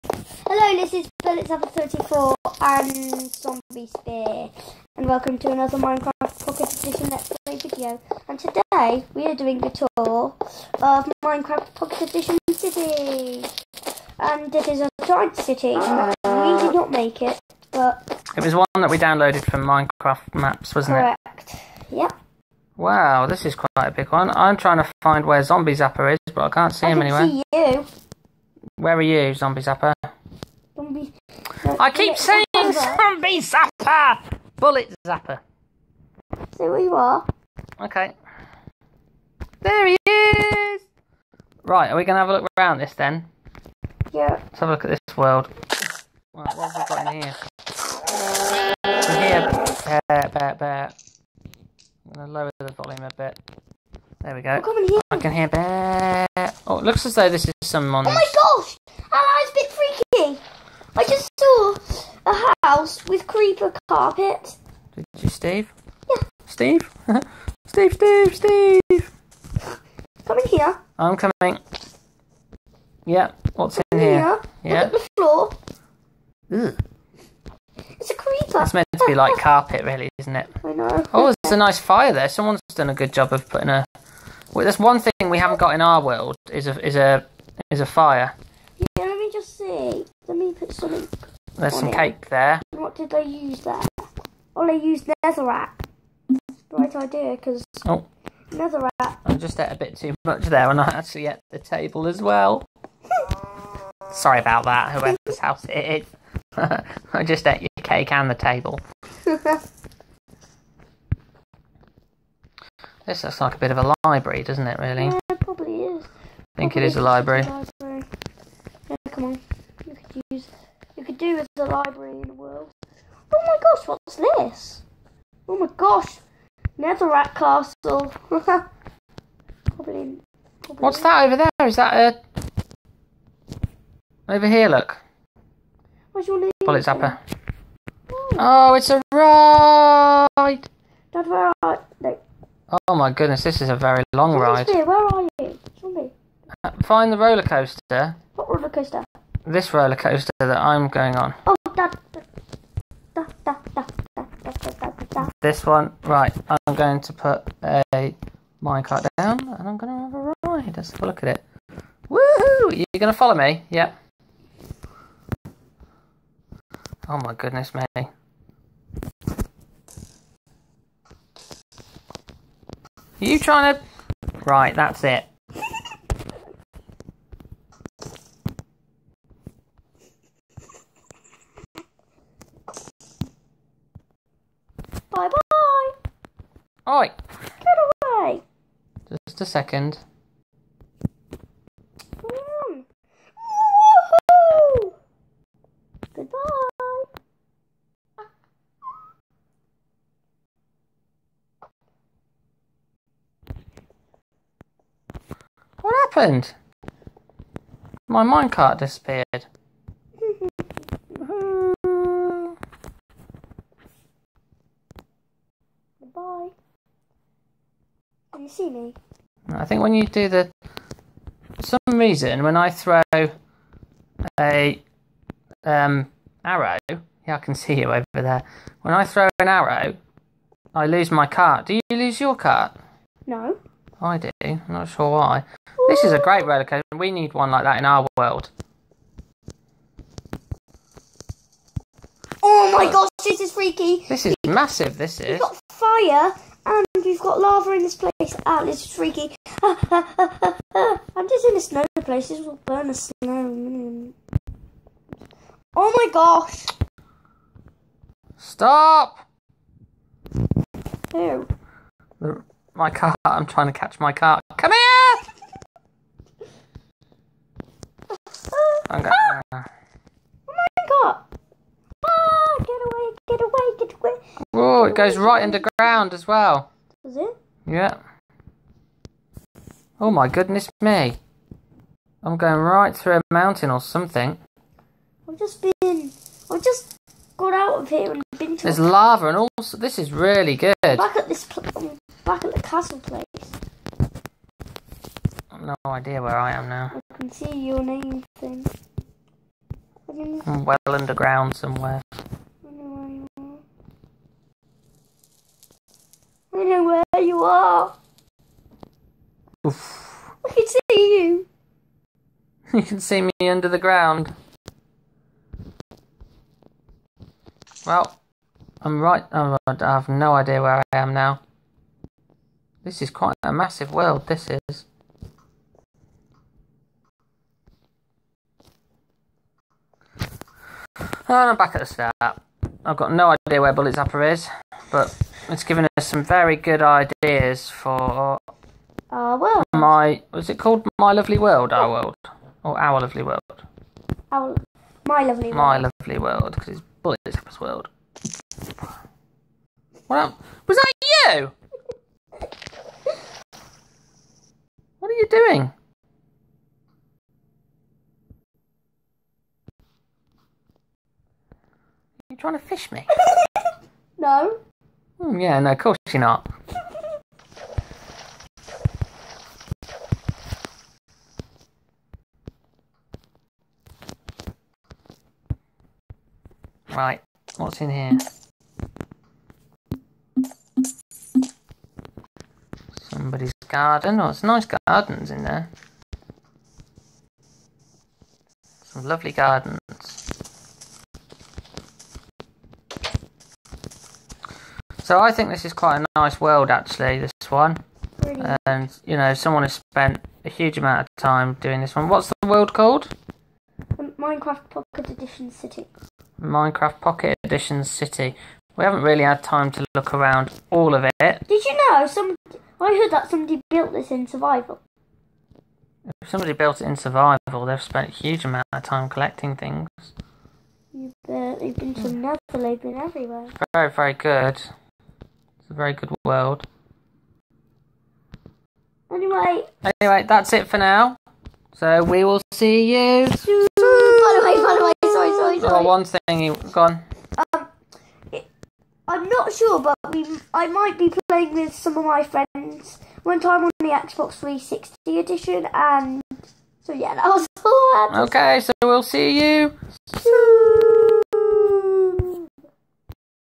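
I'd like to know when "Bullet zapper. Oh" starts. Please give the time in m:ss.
2:16.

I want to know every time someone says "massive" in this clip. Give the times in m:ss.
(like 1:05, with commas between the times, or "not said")
4:04, 5:23.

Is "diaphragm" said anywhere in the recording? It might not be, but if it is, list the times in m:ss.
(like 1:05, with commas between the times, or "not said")
not said.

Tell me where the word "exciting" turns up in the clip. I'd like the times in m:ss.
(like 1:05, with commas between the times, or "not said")
not said.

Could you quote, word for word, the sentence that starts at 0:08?
And today we are doing the tour of Minecraft Pocket Edition City.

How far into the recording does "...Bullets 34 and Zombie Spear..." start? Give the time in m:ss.
0:01.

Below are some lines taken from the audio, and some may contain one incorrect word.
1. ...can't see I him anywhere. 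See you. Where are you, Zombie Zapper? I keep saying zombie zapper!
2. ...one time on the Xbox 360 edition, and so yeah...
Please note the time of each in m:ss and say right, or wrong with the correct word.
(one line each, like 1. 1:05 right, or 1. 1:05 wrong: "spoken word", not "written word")
1. 0:26 right
2. 7:23 right.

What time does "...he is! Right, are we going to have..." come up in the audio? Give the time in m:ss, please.
0:39.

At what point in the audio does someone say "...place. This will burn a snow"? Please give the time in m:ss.
4:12.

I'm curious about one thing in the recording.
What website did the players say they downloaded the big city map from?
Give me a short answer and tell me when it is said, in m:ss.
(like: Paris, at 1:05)
Minecraft Maps, at 0:19.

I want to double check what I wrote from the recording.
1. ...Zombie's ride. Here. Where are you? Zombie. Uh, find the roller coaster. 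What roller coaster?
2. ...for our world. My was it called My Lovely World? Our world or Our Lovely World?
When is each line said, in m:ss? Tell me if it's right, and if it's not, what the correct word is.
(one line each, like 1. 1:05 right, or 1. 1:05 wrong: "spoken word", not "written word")
1. 2:24 right
2. 5:37 right.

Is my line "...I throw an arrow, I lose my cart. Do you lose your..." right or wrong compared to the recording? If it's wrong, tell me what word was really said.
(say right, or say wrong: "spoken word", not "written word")
right.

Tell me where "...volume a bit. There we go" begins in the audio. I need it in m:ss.
0:52.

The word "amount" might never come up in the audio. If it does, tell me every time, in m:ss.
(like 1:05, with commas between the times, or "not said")
6:40, 6:58.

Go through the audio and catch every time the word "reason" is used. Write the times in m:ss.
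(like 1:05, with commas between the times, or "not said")
3:41.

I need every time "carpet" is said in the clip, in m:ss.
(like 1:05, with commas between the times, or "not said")
1:03, 1:19.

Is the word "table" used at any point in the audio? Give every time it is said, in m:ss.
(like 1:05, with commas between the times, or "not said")
1:41, 1:48.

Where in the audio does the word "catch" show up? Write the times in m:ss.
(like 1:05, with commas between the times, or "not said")
4:23.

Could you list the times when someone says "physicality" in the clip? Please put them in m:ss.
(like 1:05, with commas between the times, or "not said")
not said.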